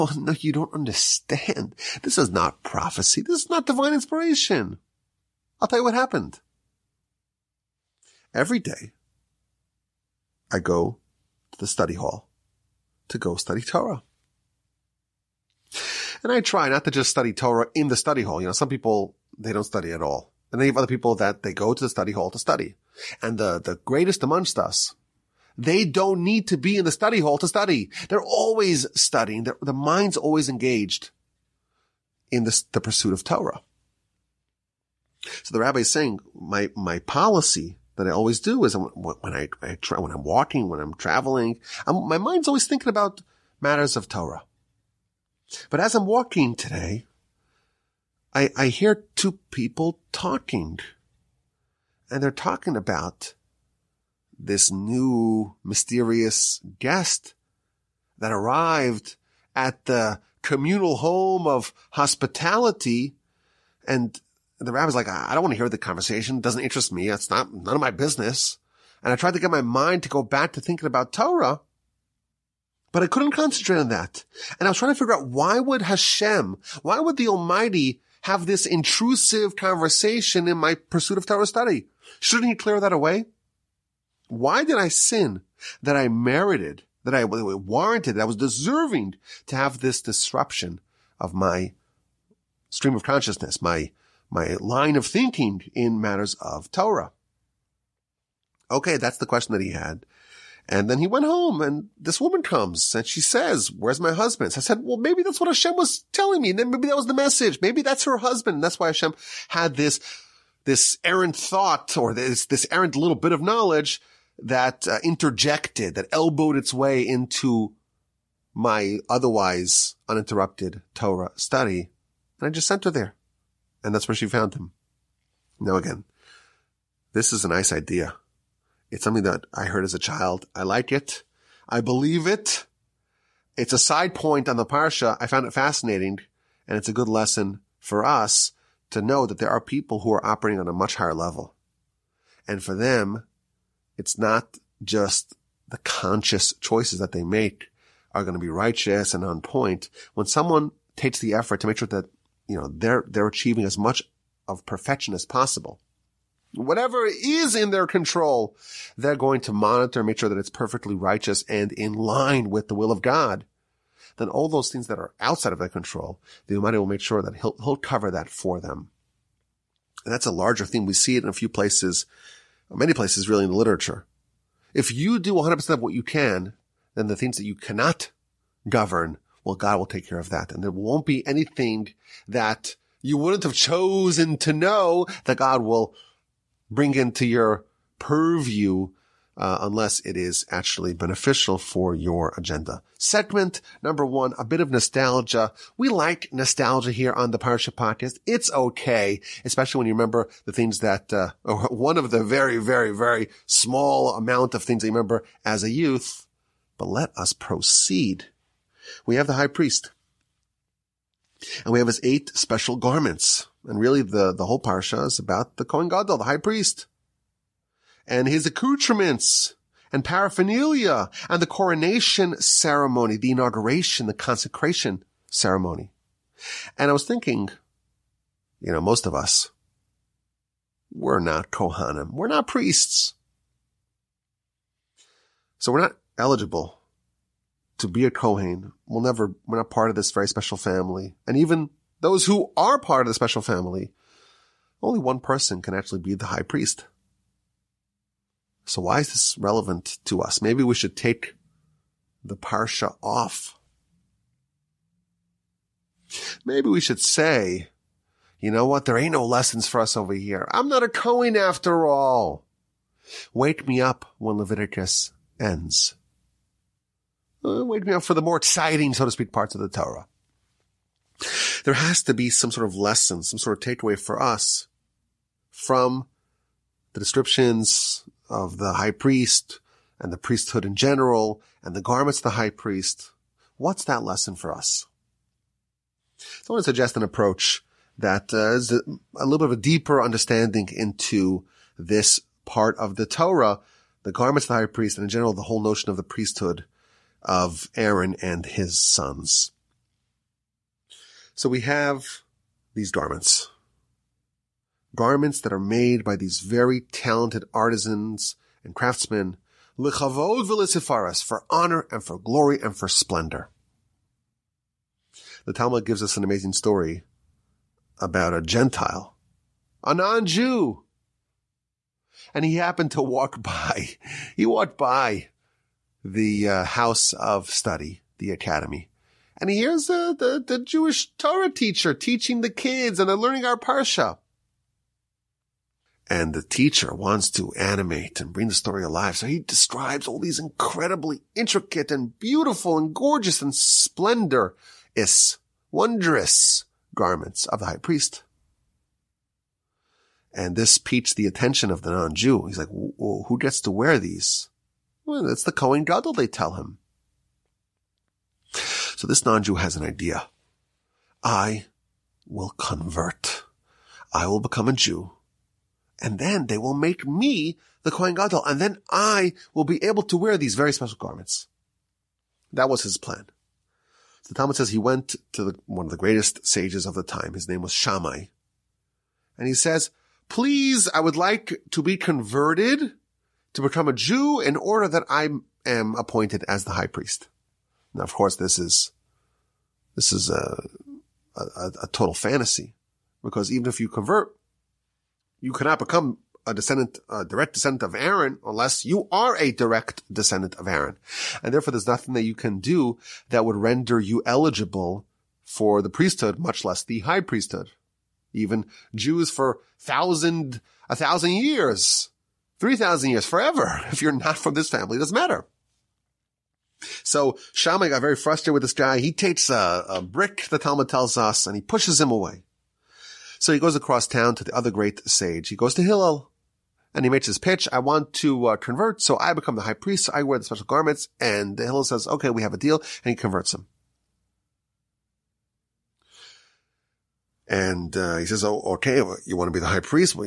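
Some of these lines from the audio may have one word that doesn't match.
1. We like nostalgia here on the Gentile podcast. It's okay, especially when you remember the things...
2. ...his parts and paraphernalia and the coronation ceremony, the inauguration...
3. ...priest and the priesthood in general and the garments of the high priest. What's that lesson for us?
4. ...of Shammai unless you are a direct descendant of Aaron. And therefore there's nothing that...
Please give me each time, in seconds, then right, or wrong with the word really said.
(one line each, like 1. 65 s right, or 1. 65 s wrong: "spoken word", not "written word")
1. 195 s wrong: "Parsha", not "Gentile"
2. 218 s wrong: "accoutrements", not "parts"
3. 278 s right
4. 397 s wrong: "Aaron", not "Shammai".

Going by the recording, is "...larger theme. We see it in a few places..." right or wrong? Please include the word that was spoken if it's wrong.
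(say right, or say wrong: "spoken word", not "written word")
right.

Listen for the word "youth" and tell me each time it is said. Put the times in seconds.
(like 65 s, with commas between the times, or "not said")
205 s.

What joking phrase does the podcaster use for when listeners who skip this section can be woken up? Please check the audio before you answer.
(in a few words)
When Leviticus ends.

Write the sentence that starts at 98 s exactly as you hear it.
Okay, that's the question that he had.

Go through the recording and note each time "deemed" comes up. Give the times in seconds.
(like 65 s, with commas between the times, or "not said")
not said.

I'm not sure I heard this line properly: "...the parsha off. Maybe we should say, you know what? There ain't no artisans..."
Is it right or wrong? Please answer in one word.
wrong.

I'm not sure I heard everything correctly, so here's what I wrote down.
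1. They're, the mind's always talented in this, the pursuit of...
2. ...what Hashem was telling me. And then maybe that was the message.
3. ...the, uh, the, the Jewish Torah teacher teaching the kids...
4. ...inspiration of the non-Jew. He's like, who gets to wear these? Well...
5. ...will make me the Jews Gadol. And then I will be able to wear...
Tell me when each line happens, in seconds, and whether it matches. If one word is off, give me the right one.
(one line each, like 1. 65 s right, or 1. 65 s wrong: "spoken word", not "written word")
1. 29 s wrong: "engaged", not "talented"
2. 105 s right
3. 329 s right
4. 351 s wrong: "attention", not "inspiration"
5. 366 s wrong: "Kohen", not "Jews".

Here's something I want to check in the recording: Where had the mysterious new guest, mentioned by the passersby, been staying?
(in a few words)
Communal home of hospitality.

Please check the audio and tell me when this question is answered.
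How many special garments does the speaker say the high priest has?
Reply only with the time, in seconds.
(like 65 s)
212 s.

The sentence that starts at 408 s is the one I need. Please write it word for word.
Even Jews for thousand, a thousand years 3,000 years, forever.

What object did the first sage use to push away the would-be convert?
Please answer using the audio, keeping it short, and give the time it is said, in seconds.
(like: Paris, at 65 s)
A brick, at 420 s.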